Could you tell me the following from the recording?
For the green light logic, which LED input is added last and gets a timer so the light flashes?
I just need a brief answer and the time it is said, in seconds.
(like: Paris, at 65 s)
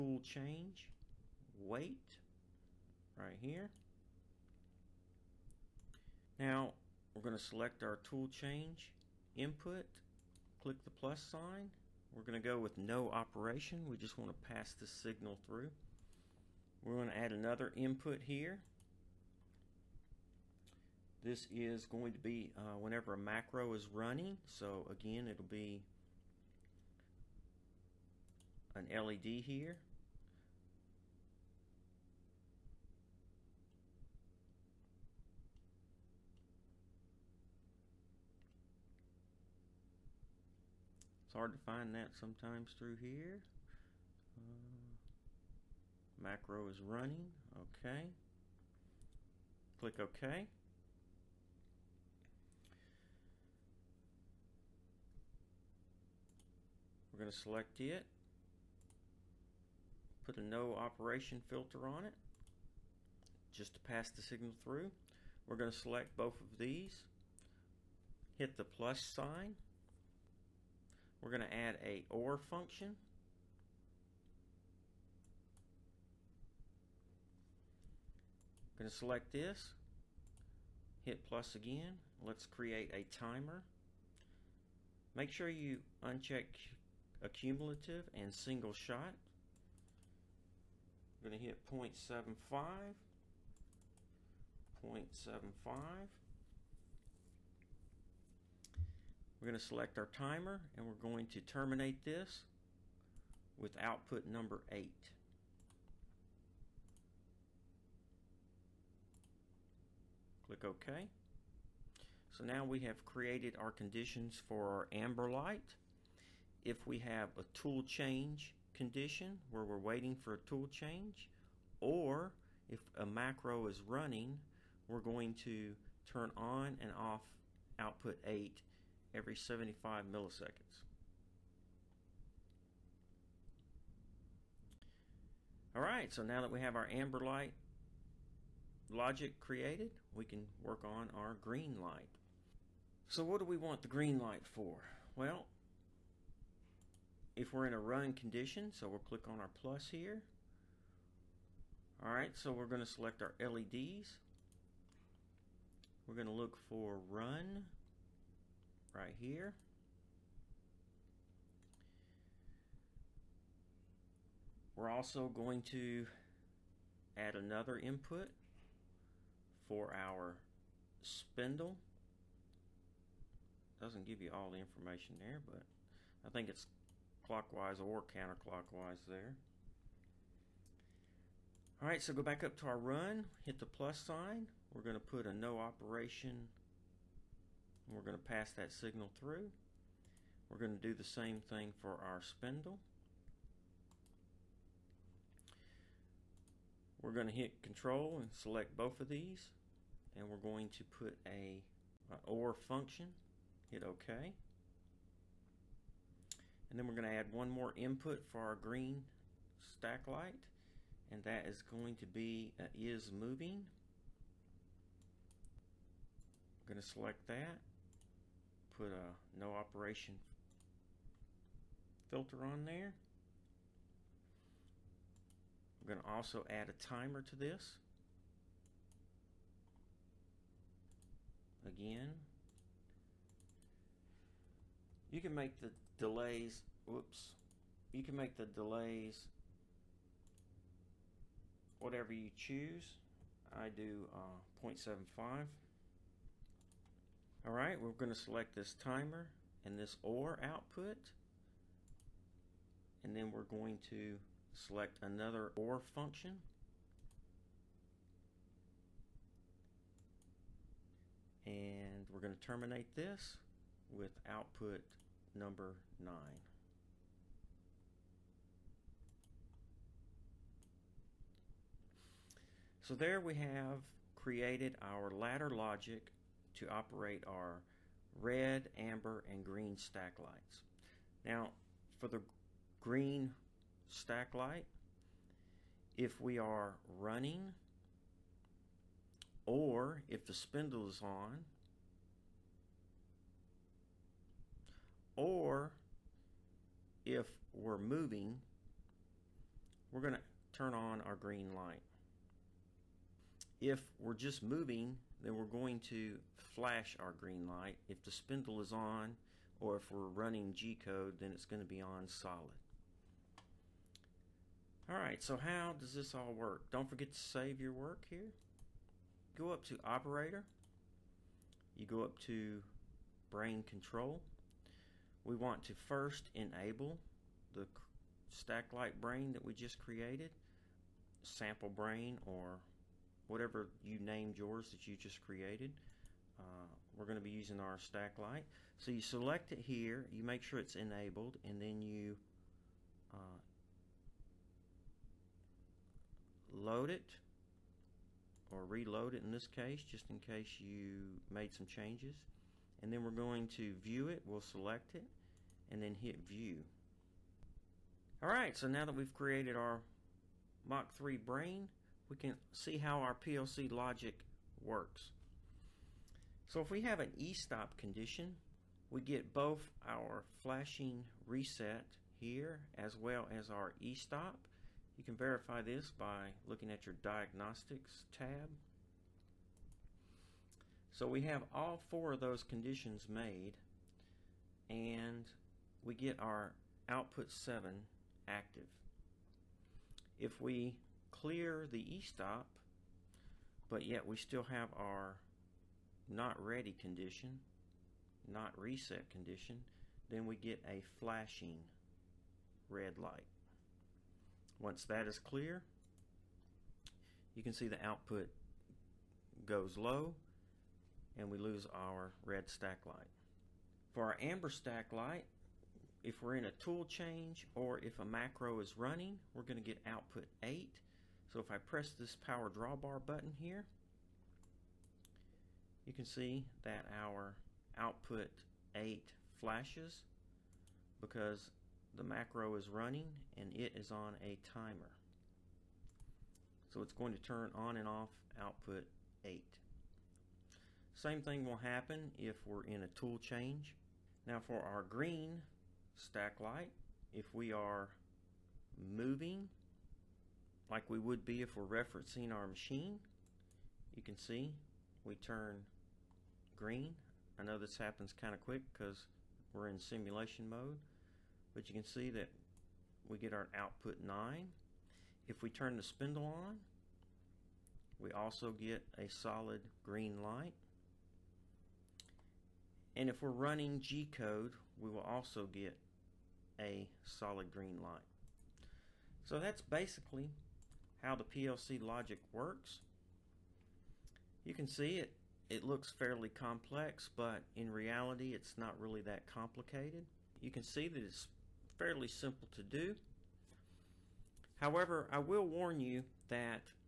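Is moving, at 212 s.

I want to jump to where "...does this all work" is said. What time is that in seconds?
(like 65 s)
315 s.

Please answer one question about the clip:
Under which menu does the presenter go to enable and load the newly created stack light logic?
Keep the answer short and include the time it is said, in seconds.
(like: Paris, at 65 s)
Brain control, at 323 s.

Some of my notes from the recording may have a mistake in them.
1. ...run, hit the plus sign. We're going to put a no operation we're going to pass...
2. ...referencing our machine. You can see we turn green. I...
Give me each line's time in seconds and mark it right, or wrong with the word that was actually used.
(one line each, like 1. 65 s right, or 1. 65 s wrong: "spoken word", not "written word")
1. 182 s right
2. 451 s right.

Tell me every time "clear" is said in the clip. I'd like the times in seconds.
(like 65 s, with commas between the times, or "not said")
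391 s, 405 s.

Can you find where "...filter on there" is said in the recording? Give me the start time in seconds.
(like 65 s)
222 s.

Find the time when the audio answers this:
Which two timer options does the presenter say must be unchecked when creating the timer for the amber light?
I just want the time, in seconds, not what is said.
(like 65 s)
87 s.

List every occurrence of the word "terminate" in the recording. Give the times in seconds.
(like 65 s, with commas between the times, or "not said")
101 s, 262 s.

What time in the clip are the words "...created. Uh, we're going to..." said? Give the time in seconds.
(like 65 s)
335 s.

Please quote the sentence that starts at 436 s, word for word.
So it's going to turn on and off output 8.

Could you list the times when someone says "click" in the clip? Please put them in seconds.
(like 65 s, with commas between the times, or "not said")
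10 s, 49 s, 110 s, 148 s.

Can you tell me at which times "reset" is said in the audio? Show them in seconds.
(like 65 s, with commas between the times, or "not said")
371 s, 398 s.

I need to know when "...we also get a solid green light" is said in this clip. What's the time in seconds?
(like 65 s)
467 s.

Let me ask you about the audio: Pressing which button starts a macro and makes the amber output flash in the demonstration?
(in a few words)
Power drawbar.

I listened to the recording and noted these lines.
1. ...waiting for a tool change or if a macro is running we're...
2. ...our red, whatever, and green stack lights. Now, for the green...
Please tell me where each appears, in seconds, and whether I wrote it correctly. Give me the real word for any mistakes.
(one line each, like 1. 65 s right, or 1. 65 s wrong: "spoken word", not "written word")
1. 119 s right
2. 277 s wrong: "amber", not "whatever".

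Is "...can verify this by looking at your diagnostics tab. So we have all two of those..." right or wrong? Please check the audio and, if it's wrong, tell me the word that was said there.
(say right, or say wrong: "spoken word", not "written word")
wrong: "four", not "two".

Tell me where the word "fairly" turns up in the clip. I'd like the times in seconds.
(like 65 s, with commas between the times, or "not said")
485 s, 491 s.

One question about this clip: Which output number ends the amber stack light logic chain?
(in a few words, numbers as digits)
8.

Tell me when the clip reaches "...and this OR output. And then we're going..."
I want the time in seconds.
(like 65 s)
249 s.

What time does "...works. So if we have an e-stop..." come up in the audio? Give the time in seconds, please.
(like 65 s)
364 s.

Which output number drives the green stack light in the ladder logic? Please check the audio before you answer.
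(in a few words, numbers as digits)
9.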